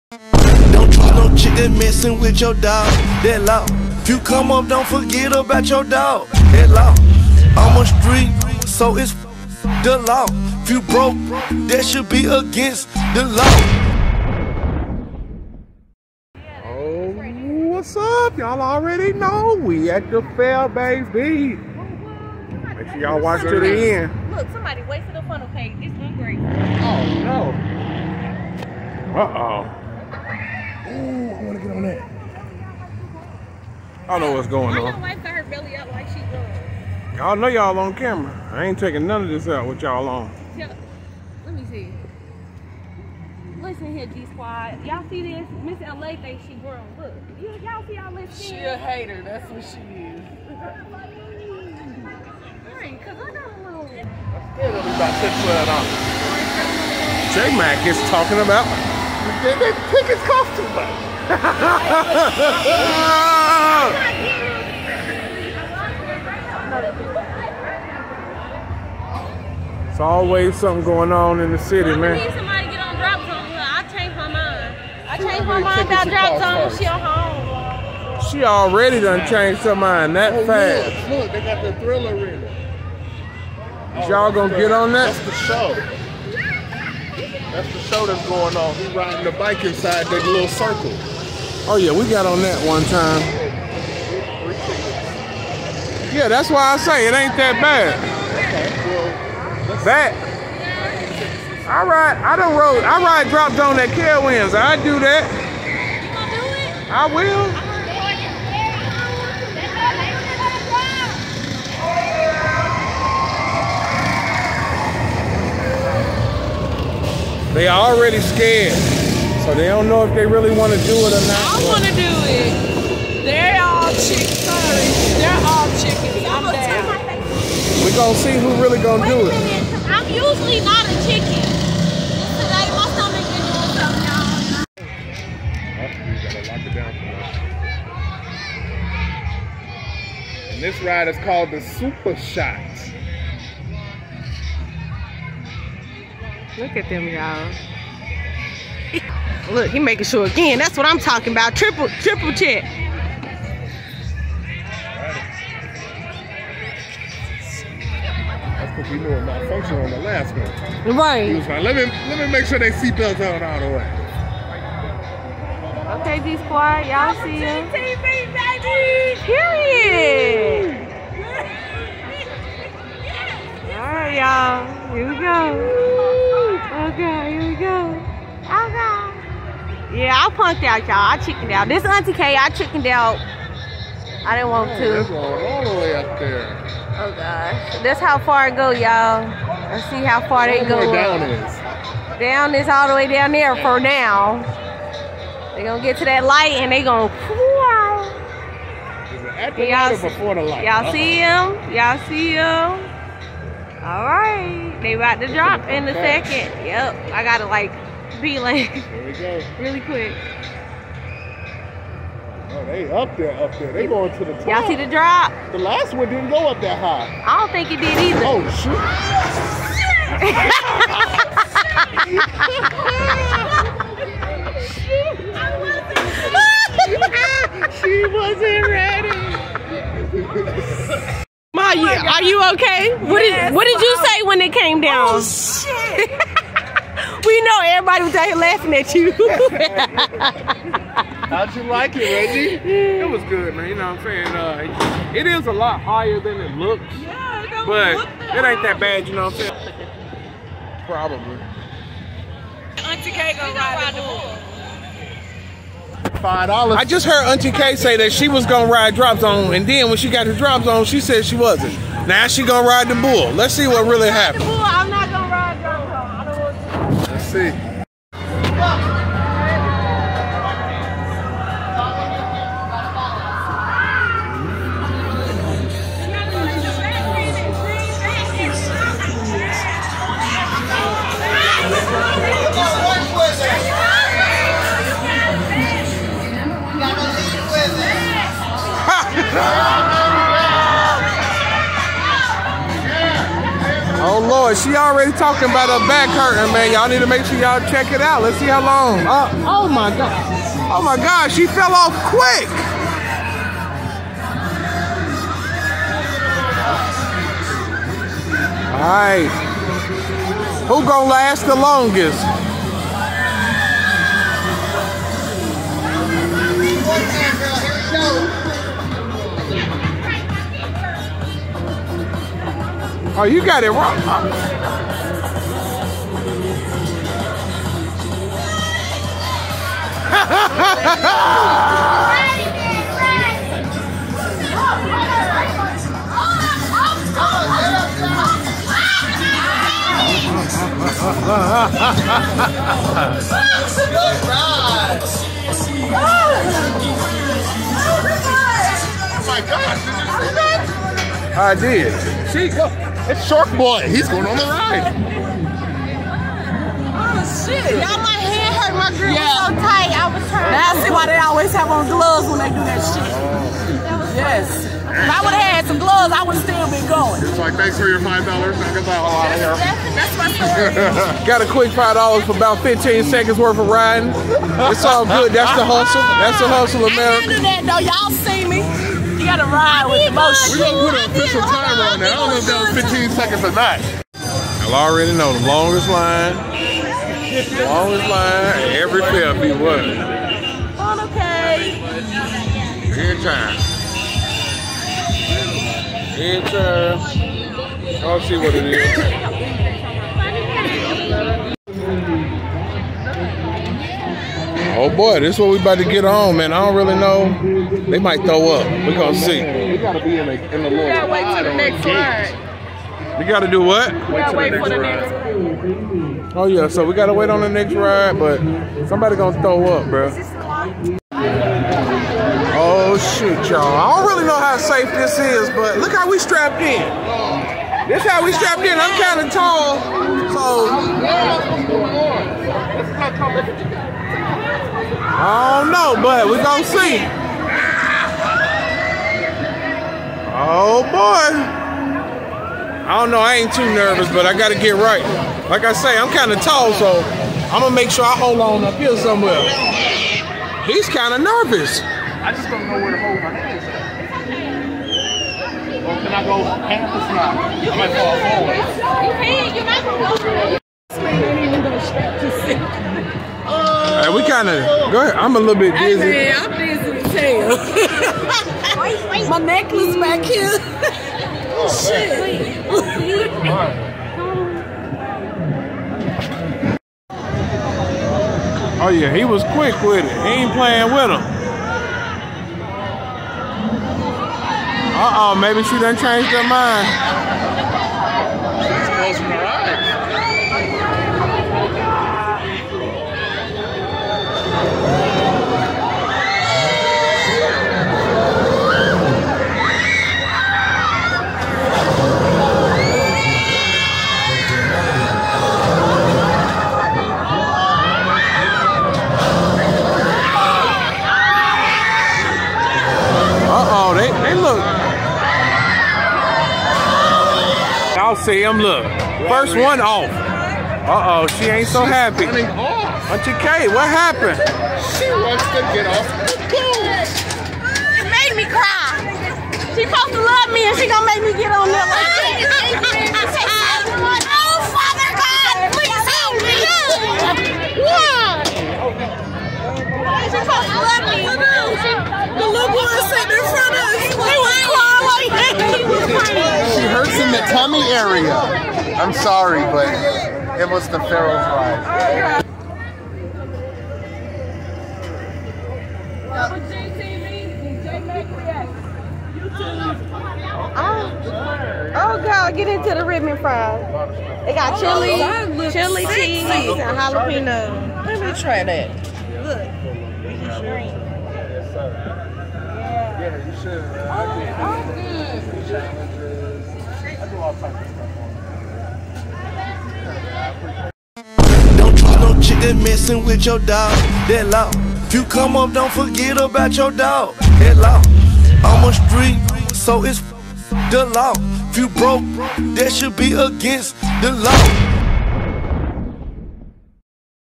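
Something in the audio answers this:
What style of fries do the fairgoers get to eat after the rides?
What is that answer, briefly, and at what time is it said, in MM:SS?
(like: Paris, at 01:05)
Ribbon fries, at 09:23.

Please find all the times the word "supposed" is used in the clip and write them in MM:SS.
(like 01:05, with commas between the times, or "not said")
08:49, 09:00.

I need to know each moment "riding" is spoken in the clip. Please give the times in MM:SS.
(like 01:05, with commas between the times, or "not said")
01:28, 06:13.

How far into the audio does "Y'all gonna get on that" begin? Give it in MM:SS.
01:24.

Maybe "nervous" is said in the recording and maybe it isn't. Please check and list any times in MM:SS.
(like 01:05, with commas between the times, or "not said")
07:23, 07:31.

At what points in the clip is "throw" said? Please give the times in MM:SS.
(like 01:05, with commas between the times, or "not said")
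06:48, 06:59.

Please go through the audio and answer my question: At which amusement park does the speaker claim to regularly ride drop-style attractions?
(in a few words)
Carowinds.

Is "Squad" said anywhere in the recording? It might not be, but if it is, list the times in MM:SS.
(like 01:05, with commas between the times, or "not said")
00:44, 02:46.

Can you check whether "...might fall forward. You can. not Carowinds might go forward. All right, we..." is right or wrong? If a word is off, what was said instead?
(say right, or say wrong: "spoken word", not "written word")
wrong: "You", not "Carowinds".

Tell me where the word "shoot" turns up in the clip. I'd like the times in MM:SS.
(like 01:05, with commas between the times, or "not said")
03:38, 07:03.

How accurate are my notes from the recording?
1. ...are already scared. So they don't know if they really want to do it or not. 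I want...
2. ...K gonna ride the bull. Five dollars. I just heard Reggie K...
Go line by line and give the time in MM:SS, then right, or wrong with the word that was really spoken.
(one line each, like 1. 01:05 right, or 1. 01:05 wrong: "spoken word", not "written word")
1. 01:57 right
2. 04:13 wrong: "Auntie", not "Reggie".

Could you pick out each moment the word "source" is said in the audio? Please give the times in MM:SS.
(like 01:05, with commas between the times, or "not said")
not said.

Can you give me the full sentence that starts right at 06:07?
It's like, thanks for your $5.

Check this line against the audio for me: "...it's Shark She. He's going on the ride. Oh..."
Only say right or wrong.
wrong.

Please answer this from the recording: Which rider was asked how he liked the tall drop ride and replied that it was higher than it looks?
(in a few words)
Reggie.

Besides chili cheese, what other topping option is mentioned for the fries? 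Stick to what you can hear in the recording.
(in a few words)
Jalapeno.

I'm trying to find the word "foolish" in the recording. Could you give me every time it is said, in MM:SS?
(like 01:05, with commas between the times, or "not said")
not said.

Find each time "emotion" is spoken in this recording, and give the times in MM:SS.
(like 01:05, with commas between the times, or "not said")
06:20.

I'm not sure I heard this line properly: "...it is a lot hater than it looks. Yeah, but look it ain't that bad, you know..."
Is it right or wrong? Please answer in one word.
wrong.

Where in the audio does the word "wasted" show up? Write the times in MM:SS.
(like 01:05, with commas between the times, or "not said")
00:24.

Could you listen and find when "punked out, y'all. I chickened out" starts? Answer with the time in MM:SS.
03:00.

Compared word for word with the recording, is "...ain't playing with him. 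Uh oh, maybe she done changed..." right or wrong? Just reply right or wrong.
right.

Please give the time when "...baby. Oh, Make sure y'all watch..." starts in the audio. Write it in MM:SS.
00:20.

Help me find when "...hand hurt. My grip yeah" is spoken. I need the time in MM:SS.
05:58.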